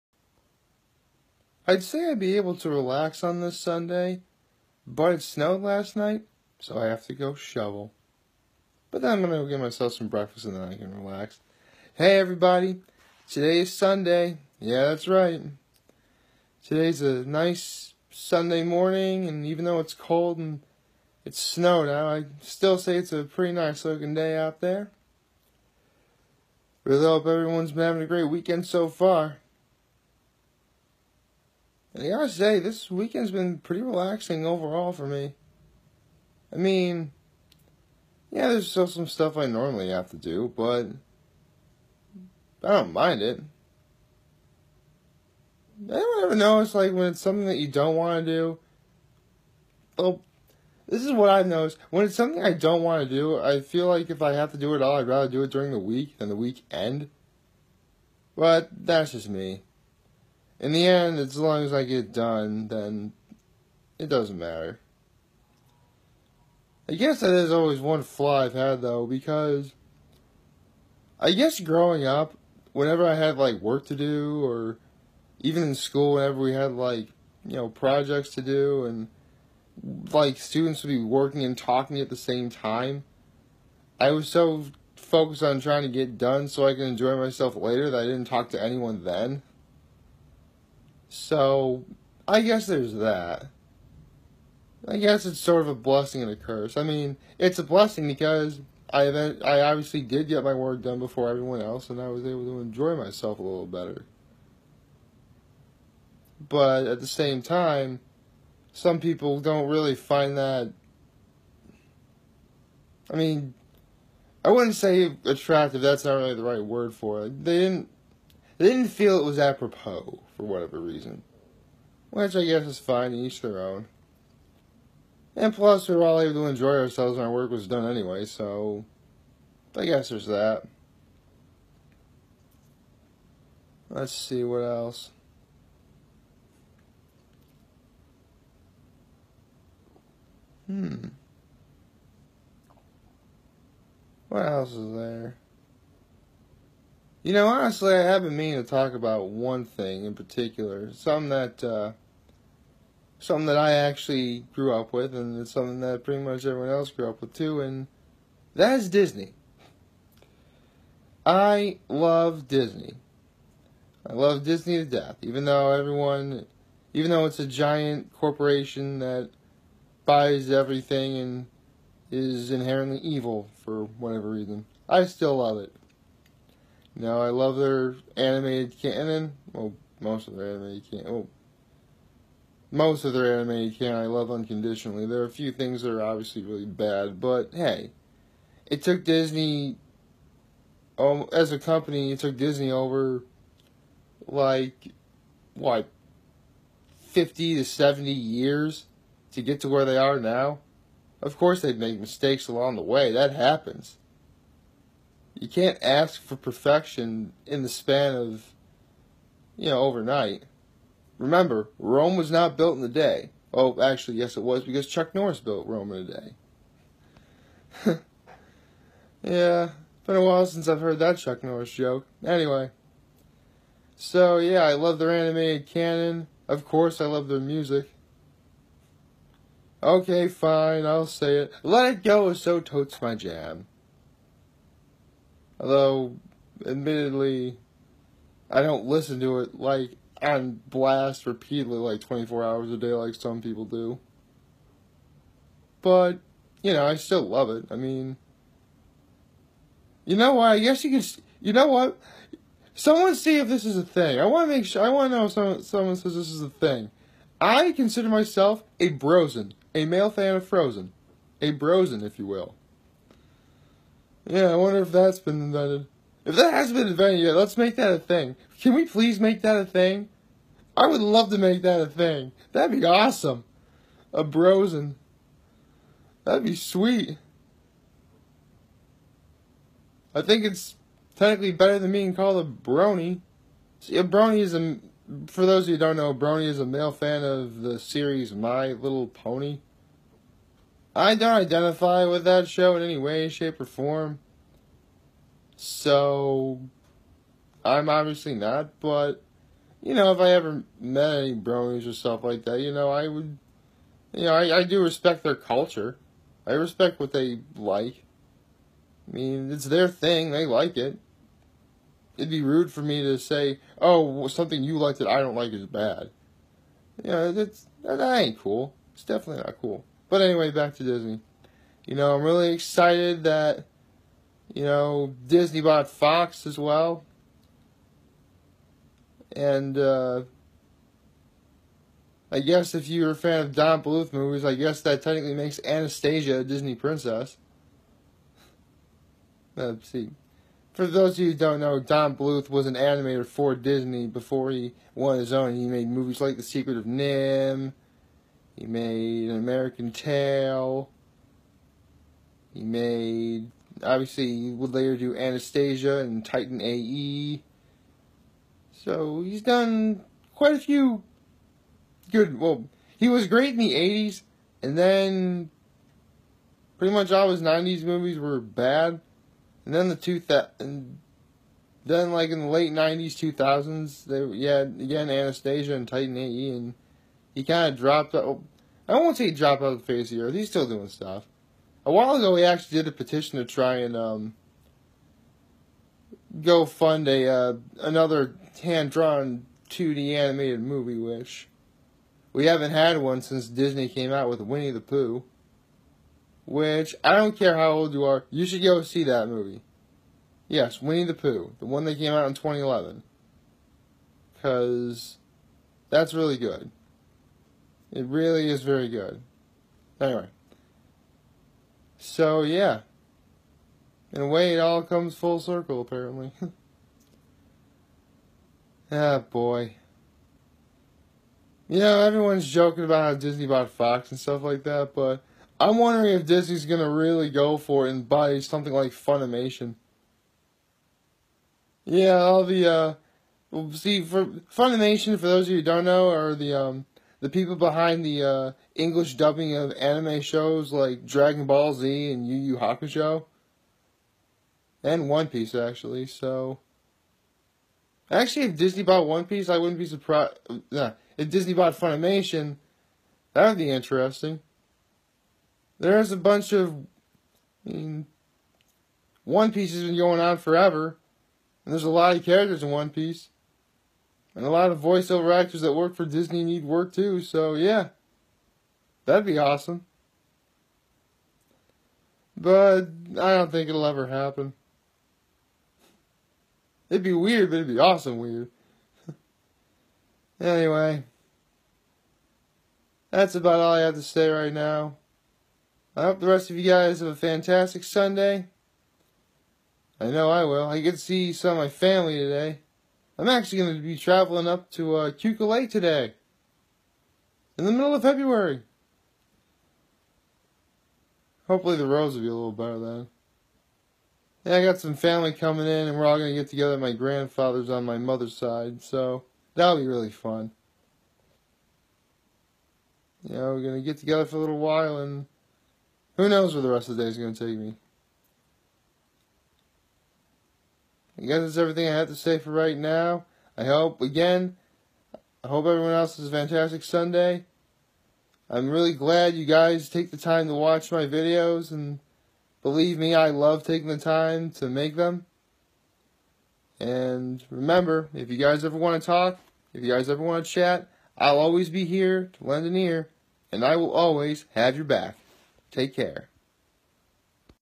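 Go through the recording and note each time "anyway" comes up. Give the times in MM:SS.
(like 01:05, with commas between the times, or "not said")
02:07, 03:42, 05:20, 06:49, 08:00.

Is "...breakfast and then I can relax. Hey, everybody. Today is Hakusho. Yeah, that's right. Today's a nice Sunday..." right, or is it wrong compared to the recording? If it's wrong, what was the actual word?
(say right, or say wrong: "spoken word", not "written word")
wrong: "Sunday", not "Hakusho".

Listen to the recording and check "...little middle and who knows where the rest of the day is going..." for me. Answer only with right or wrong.
wrong.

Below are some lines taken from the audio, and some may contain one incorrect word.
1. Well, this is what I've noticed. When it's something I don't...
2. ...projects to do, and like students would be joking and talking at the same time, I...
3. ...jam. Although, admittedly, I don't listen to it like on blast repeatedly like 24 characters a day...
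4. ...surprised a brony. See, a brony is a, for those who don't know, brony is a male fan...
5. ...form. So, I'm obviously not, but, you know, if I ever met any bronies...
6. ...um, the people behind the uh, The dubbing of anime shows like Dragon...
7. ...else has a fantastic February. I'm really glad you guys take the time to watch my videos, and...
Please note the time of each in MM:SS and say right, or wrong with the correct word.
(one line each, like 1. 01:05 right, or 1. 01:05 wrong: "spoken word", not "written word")
1. 00:49 right
2. 01:17 wrong: "working", not "joking"
3. 03:53 wrong: "hours", not "characters"
4. 04:42 wrong: "called", not "surprised"
5. 04:53 right
6. 07:16 wrong: "English", not "The"
7. 08:45 wrong: "Sunday", not "February".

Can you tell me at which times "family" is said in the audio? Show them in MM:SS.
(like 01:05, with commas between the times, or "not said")
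08:11, 08:24.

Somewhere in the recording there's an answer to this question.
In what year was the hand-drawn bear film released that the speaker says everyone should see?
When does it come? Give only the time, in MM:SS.
06:42.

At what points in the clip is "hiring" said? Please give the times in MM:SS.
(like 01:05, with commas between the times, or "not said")
not said.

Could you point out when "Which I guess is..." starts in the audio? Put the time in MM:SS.
02:02.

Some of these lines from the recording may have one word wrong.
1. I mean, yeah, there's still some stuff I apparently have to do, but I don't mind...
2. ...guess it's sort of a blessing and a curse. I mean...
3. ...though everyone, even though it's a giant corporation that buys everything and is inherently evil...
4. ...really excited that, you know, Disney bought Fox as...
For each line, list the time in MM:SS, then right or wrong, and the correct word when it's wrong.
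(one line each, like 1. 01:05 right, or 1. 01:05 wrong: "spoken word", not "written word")
1. 00:36 wrong: "normally", not "apparently"
2. 01:34 right
3. 02:45 right
4. 05:22 right.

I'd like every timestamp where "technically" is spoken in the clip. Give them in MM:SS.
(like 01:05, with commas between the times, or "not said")
04:41, 05:35.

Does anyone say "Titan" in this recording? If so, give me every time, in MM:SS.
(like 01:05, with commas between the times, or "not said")
05:56, 06:15.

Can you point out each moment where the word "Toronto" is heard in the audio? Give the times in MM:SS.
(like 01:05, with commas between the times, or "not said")
not said.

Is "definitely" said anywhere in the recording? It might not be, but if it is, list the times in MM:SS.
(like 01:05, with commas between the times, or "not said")
05:19.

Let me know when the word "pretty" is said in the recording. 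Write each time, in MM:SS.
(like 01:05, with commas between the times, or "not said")
00:23, 00:33, 02:36, 06:06.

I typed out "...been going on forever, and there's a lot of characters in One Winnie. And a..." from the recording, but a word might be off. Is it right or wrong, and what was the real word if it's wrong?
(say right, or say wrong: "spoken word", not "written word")
wrong: "Piece", not "Winnie".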